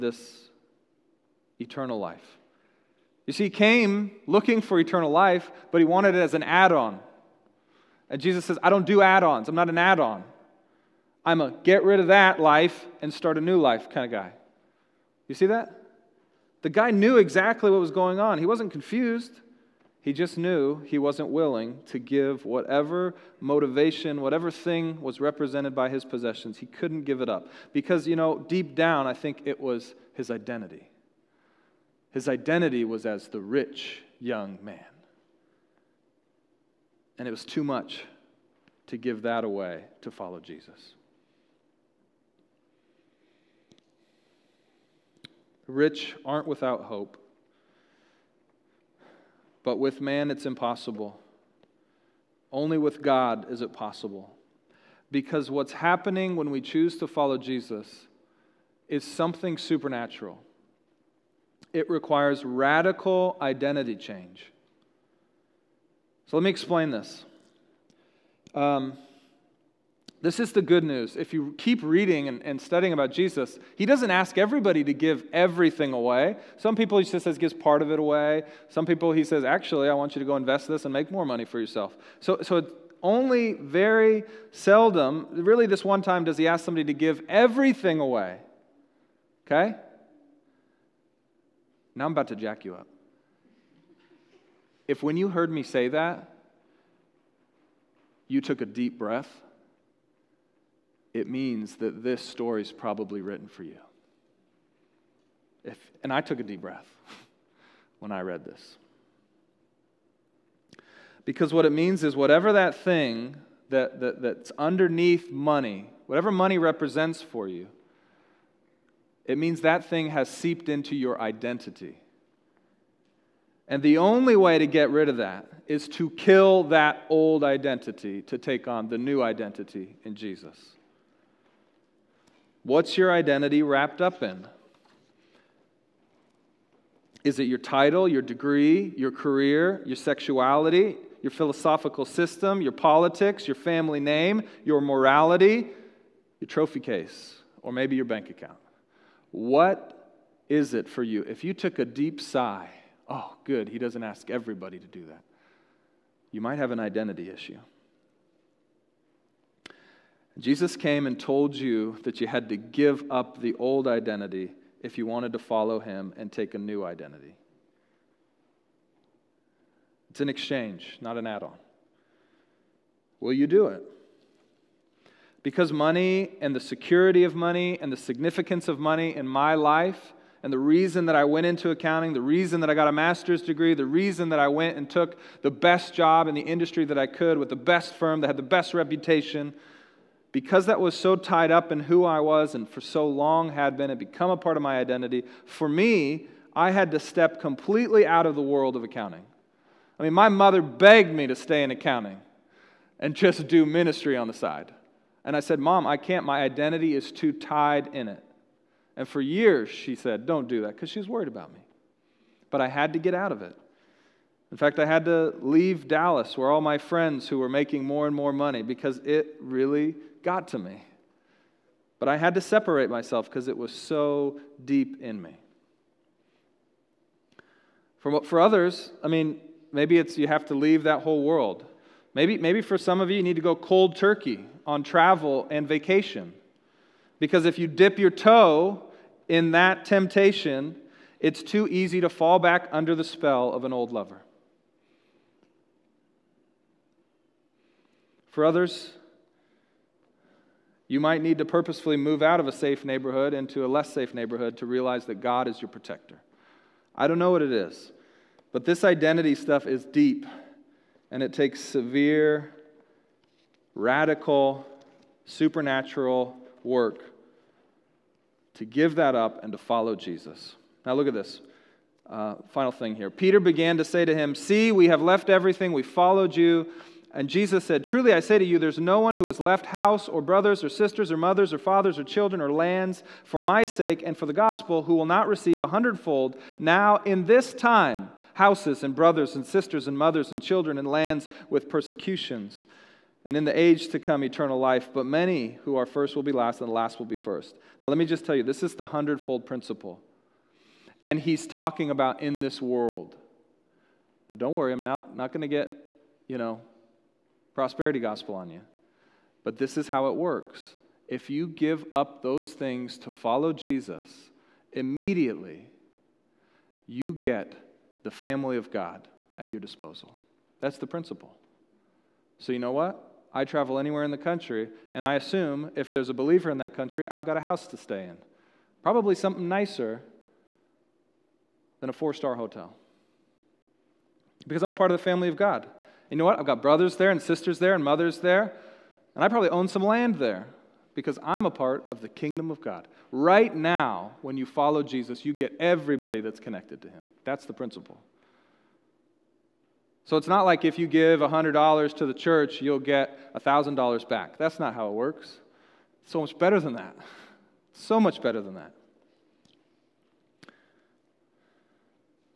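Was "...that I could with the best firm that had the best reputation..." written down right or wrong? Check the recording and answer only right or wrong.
right.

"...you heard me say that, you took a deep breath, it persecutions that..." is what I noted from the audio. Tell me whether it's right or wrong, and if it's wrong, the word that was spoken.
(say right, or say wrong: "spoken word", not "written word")
wrong: "means", not "persecutions".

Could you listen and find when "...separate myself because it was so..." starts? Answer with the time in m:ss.
3:42.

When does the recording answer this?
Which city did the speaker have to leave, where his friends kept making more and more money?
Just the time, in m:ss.
3:35.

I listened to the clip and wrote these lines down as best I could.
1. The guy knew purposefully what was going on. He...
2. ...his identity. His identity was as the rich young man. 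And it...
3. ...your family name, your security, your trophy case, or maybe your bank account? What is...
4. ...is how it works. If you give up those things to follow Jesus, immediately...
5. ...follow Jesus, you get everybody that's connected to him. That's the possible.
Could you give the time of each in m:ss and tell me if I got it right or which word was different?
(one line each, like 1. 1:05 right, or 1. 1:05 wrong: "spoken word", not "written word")
1. 0:16 wrong: "exactly", not "purposefully"
2. 0:30 right
3. 2:23 wrong: "morality", not "security"
4. 5:09 right
5. 5:44 wrong: "principle", not "possible".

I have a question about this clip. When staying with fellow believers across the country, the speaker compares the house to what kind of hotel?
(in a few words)
A four star hotel.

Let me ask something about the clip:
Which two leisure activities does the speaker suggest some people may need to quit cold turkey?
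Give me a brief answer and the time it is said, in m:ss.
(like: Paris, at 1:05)
Travel and vacation, at 3:54.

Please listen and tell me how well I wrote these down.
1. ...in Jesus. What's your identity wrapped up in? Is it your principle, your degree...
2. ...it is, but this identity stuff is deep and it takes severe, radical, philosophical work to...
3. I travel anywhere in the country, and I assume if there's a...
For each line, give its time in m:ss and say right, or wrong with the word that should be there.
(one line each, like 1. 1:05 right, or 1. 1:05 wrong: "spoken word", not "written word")
1. 2:10 wrong: "title", not "principle"
2. 4:17 wrong: "supernatural", not "philosophical"
3. 5:23 right.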